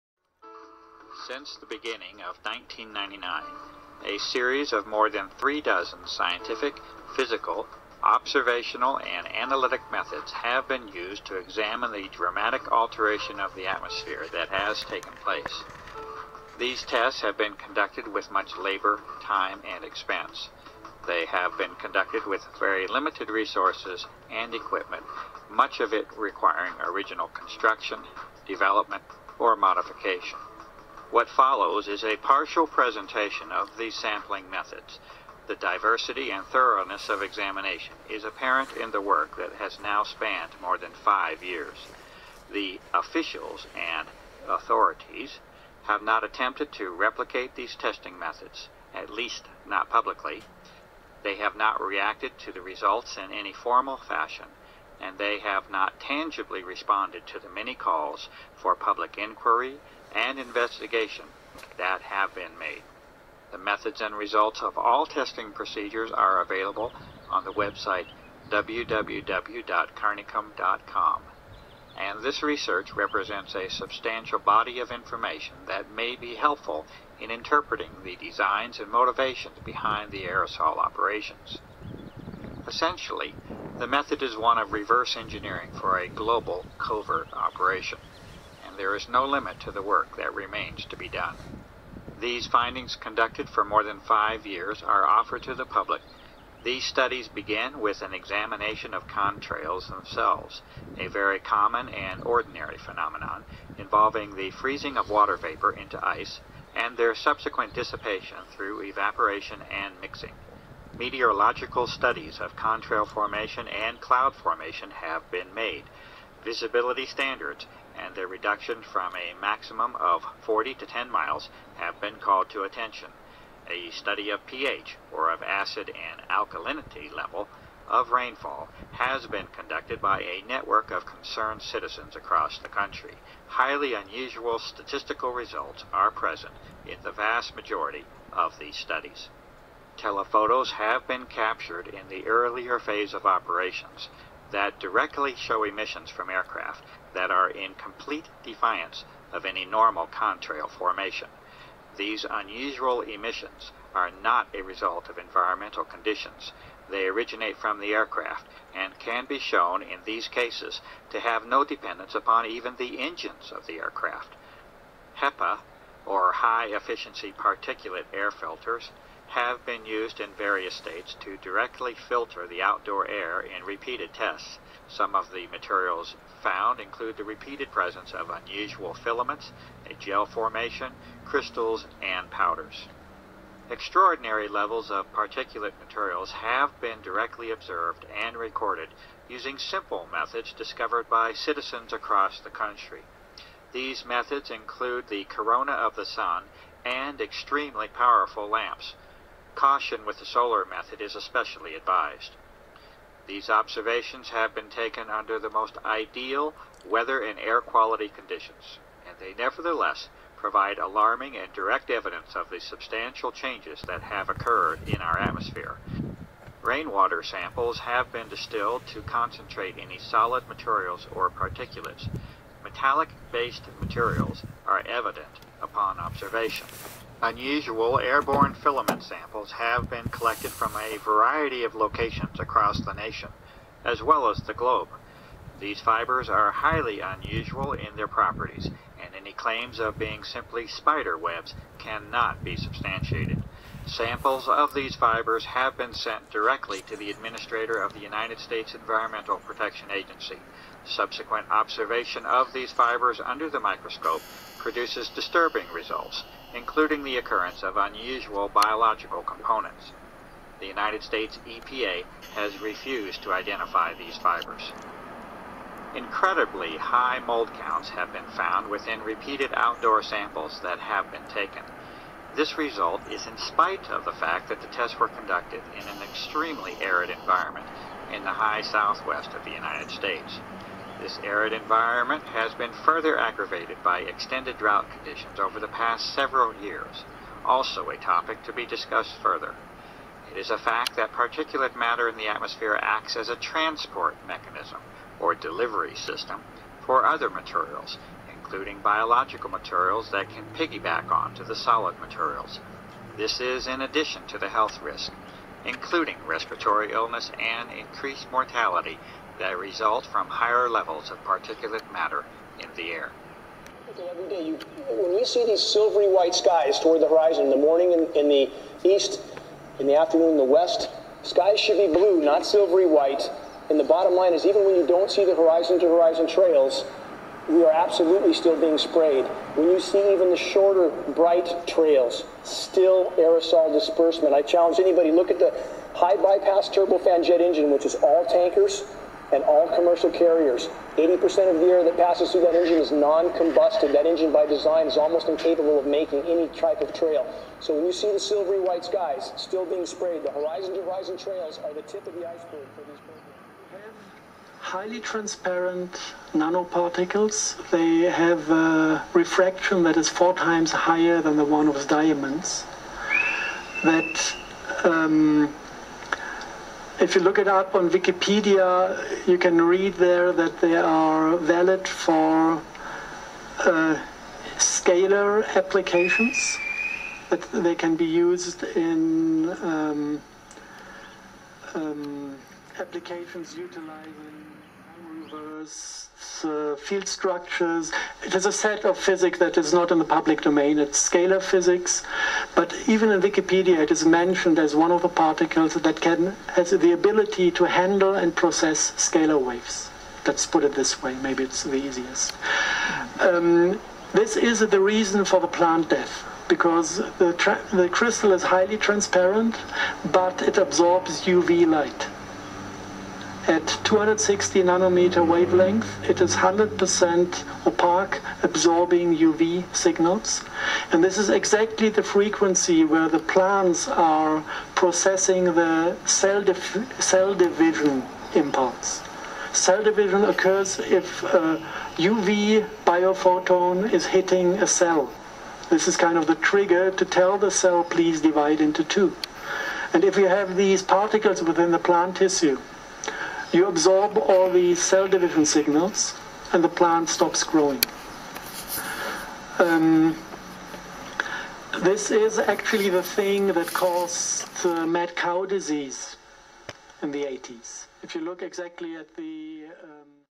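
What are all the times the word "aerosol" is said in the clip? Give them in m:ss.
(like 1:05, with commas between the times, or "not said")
1:20, 5:33.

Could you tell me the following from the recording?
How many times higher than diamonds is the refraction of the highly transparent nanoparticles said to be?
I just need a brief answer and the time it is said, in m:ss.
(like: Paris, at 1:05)
4, at 6:00.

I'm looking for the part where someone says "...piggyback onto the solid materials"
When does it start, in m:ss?
5:00.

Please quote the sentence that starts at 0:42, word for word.
The officials and authorities have not attempted to replicate these testing methods, at least not publicly.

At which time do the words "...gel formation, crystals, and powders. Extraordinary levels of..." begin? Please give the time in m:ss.
2:59.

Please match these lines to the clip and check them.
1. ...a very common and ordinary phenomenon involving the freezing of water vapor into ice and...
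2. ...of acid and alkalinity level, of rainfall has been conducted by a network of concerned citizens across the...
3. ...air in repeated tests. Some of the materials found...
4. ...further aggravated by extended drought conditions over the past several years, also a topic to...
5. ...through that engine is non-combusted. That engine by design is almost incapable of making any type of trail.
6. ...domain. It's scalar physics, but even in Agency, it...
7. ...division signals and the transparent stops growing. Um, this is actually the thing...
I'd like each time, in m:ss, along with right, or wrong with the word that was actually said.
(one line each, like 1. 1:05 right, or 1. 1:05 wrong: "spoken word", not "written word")
1. 1:40 right
2. 2:05 right
3. 2:53 right
4. 4:42 right
5. 5:42 right
6. 6:30 wrong: "Wikipedia", not "Agency"
7. 7:25 wrong: "plant", not "transparent".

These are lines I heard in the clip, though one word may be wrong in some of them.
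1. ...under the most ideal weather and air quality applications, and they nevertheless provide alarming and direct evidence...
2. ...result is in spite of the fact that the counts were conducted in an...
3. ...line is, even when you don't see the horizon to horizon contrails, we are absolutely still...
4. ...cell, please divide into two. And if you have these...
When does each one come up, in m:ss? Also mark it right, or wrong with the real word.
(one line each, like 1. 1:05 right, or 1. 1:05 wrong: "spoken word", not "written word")
1. 3:25 wrong: "conditions", not "applications"
2. 4:32 wrong: "tests", not "counts"
3. 5:24 wrong: "trails", not "contrails"
4. 7:17 right.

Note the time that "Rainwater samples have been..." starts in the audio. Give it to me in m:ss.
3:36.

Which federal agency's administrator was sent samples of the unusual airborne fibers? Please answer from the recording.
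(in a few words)
Environmental Protection Agency.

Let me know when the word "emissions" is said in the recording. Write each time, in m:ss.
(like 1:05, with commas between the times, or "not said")
2:25, 2:33.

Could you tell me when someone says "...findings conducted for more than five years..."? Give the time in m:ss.
1:32.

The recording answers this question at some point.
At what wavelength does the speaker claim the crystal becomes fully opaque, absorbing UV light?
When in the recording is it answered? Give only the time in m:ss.
6:53.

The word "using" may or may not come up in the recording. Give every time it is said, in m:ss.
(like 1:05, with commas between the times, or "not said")
3:09.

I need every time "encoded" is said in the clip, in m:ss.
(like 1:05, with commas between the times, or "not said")
not said.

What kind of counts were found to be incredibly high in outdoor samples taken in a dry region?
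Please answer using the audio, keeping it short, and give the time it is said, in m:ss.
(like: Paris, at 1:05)
mold counts, at 4:27.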